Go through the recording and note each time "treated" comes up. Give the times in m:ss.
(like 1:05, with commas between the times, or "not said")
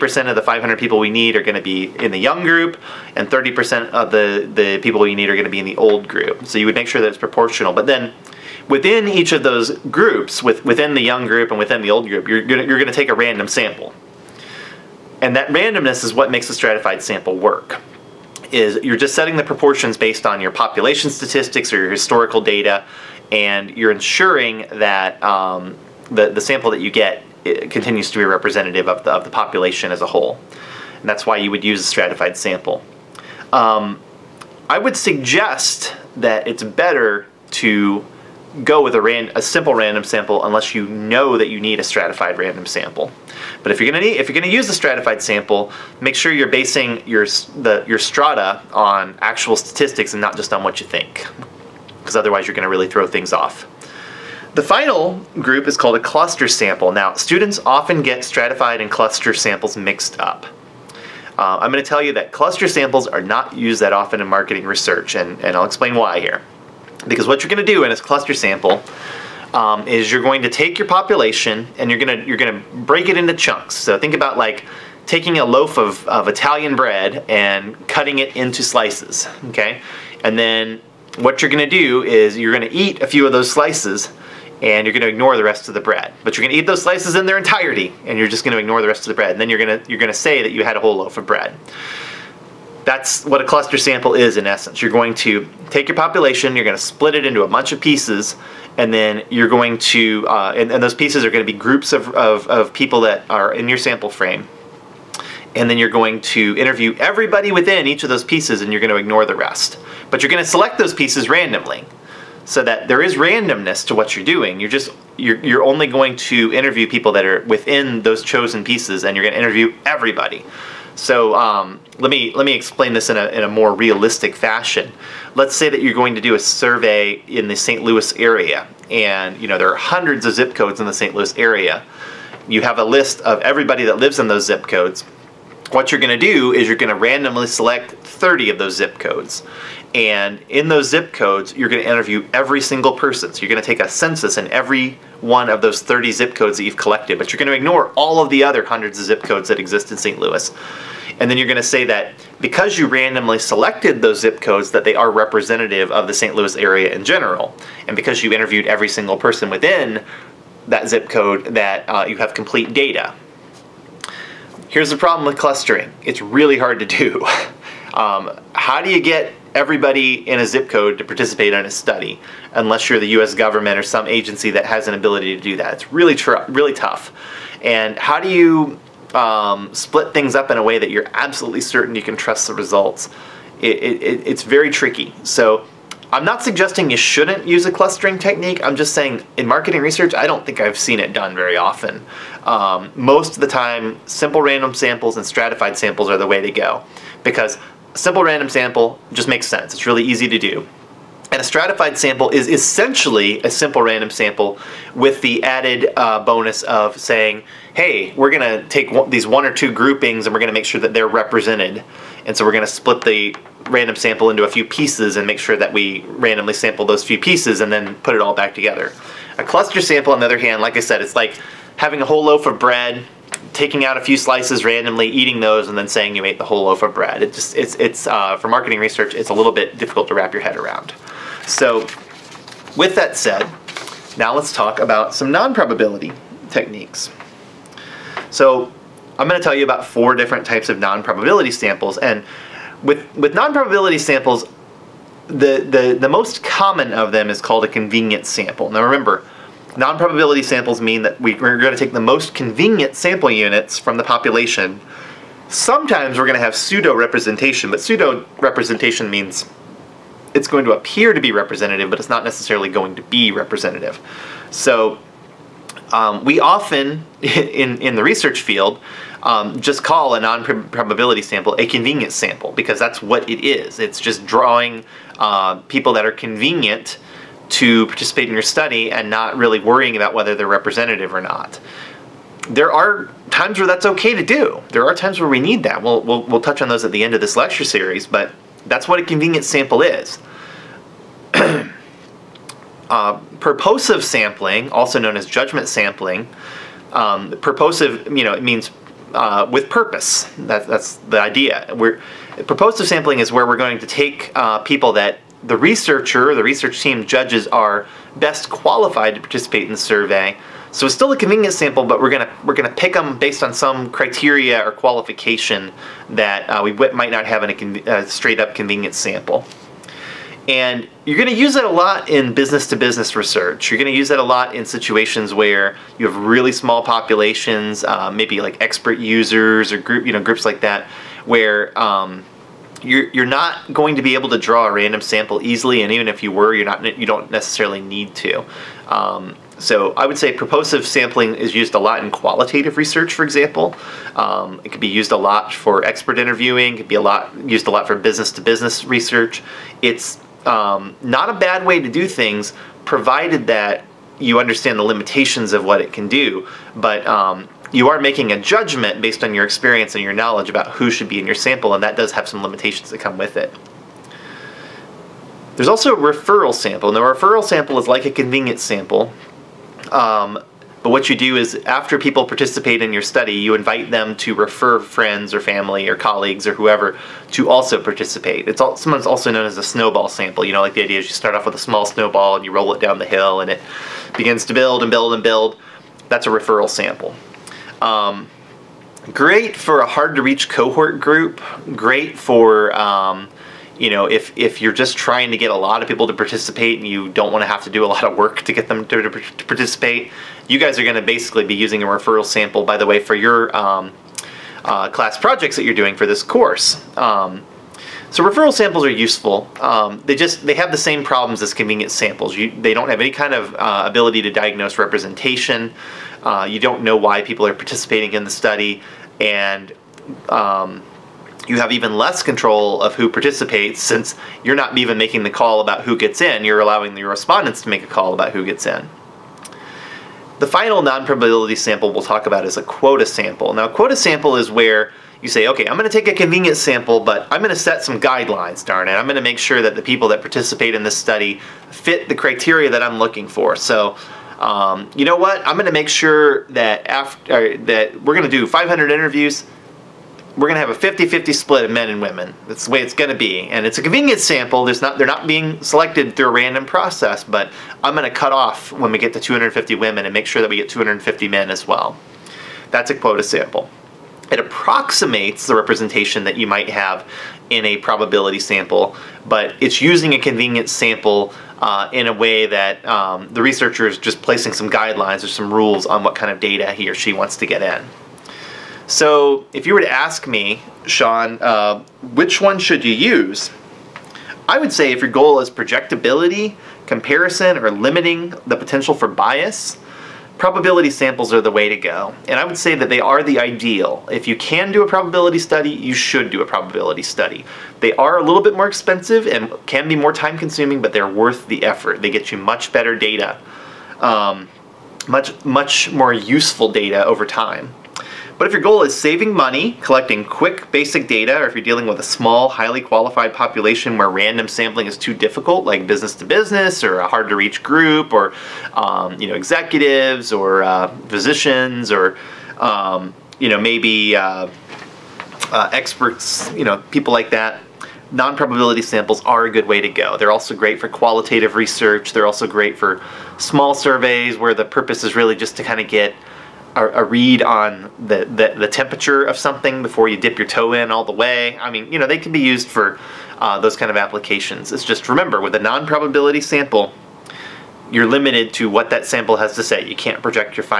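not said.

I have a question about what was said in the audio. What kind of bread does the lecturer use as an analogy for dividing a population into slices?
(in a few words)
Italian bread.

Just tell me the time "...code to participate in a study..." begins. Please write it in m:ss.
2:50.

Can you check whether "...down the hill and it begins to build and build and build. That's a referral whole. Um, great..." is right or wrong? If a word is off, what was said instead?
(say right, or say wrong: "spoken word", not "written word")
wrong: "sample", not "whole".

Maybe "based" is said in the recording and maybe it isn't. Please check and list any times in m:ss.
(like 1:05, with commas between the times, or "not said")
0:19, 5:13, 5:59.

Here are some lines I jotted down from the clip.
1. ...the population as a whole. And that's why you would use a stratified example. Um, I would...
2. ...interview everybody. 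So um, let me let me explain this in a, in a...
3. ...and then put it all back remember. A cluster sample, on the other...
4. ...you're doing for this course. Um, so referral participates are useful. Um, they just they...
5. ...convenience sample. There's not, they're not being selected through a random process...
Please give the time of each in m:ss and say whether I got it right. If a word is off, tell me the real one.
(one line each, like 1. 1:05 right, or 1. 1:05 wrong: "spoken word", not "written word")
1. 0:29 wrong: "sample", not "example"
2. 1:59 right
3. 3:37 wrong: "together", not "remember"
4. 6:45 wrong: "samples", not "participates"
5. 7:33 right.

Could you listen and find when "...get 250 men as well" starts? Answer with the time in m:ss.
7:40.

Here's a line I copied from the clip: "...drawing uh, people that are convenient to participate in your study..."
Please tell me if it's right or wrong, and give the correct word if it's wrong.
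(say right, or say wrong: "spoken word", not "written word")
right.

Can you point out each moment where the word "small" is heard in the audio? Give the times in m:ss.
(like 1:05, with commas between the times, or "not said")
5:26, 6:21, 8:32, 8:53.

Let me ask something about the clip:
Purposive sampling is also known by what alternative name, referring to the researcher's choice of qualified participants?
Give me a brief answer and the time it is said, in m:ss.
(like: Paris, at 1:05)
judgment sampling, at 4:55.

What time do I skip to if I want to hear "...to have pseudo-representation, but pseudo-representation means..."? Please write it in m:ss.
4:16.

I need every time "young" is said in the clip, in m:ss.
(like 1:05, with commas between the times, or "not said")
0:02, 0:11.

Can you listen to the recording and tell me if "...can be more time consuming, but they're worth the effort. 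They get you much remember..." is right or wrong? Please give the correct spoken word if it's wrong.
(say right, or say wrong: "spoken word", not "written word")
wrong: "better", not "remember".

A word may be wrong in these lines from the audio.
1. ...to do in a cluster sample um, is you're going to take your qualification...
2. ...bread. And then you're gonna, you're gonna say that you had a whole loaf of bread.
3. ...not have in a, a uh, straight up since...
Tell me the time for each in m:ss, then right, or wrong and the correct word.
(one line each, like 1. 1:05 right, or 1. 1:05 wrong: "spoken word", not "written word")
1. 1:07 wrong: "population", not "qualification"
2. 1:29 right
3. 5:17 wrong: "convenience", not "since".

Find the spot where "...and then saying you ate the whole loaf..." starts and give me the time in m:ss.
3:45.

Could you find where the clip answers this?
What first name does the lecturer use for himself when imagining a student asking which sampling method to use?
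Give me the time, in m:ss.
8:00.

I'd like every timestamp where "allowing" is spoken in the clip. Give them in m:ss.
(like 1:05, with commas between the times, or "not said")
7:06.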